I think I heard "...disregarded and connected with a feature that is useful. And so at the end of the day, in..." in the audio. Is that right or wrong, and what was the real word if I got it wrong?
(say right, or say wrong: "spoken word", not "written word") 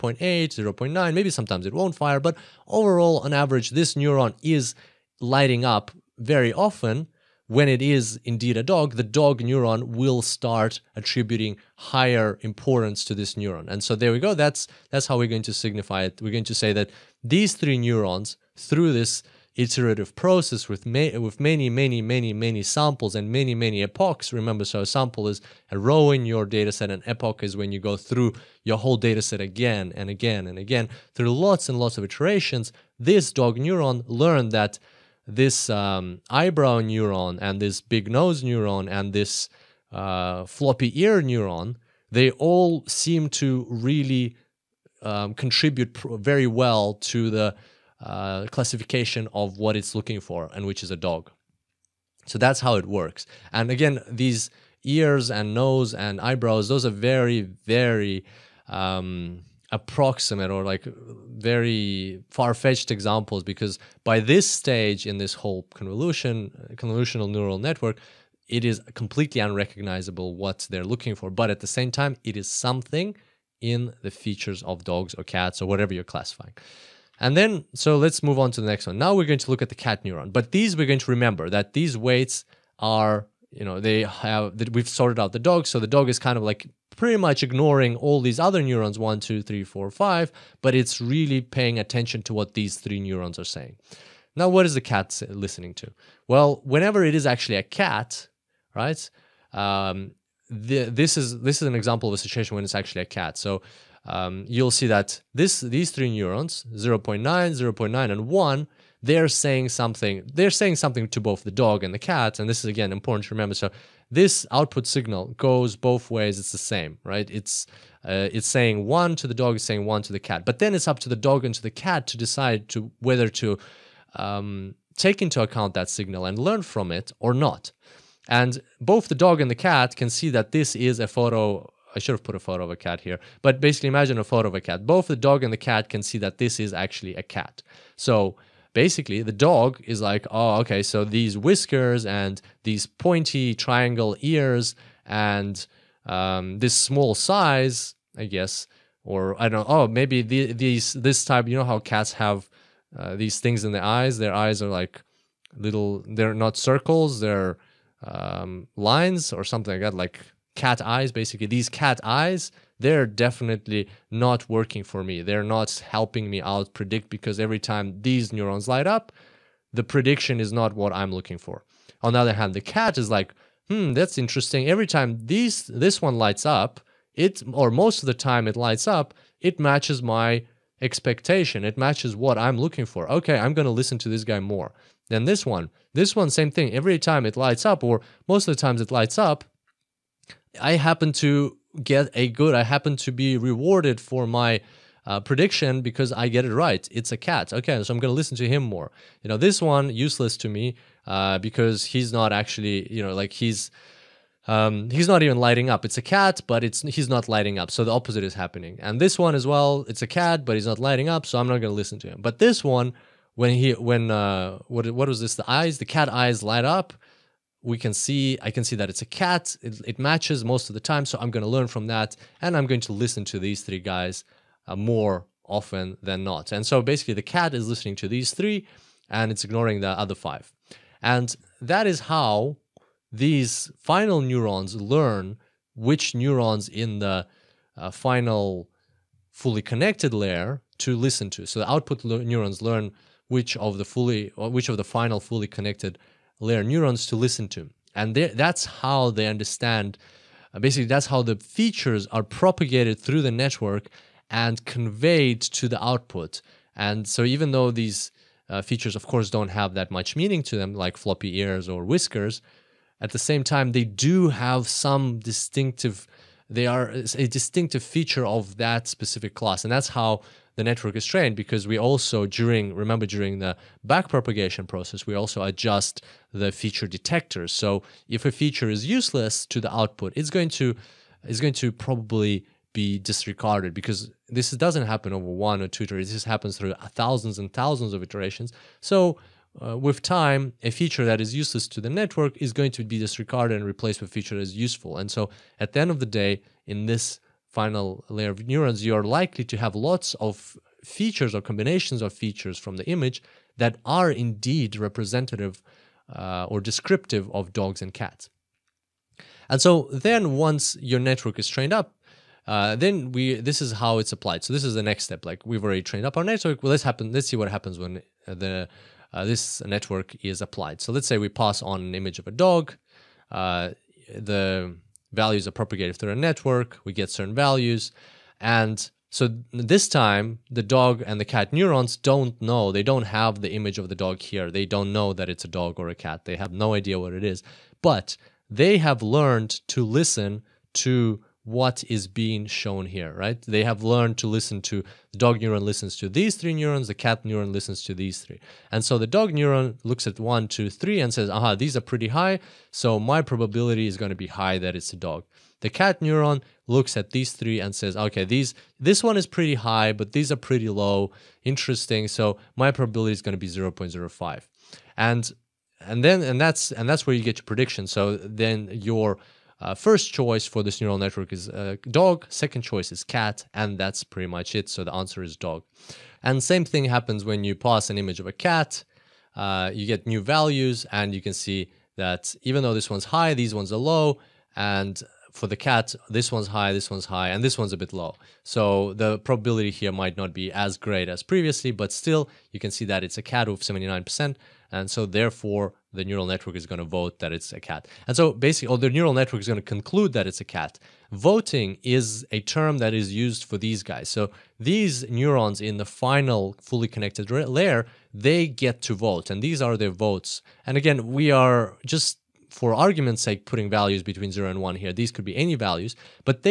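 wrong: "replaced", not "connected".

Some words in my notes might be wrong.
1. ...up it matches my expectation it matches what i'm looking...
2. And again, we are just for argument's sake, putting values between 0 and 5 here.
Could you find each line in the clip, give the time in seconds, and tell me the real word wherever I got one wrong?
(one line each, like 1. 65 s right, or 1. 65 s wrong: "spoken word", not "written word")
1. 178 s right
2. 410 s wrong: "1", not "5".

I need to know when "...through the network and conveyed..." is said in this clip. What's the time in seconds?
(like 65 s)
252 s.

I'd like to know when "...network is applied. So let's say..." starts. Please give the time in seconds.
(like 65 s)
319 s.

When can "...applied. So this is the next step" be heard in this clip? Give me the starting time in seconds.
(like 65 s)
314 s.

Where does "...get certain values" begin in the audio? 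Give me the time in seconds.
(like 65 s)
326 s.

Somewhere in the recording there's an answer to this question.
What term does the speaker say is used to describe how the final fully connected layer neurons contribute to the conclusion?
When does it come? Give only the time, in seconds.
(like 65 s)
401 s.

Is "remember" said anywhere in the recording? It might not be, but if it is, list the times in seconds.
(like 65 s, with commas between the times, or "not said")
24 s, 81 s, 113 s, 272 s.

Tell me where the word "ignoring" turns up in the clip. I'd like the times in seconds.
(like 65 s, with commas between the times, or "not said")
87 s, 229 s.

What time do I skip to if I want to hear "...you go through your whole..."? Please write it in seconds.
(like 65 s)
27 s.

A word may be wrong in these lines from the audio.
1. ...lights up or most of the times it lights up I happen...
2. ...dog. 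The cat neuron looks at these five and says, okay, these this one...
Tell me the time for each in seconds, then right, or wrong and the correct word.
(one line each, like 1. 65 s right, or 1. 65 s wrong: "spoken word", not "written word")
1. 187 s right
2. 354 s wrong: "three", not "five".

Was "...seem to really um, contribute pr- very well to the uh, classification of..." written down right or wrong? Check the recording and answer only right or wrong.
right.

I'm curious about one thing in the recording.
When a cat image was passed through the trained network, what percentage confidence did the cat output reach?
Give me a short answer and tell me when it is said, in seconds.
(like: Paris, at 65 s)
79%, at 393 s.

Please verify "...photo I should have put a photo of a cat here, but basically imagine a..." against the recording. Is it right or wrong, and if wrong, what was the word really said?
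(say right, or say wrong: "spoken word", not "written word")
right.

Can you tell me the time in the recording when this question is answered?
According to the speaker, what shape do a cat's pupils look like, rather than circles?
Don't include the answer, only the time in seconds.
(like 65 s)
158 s.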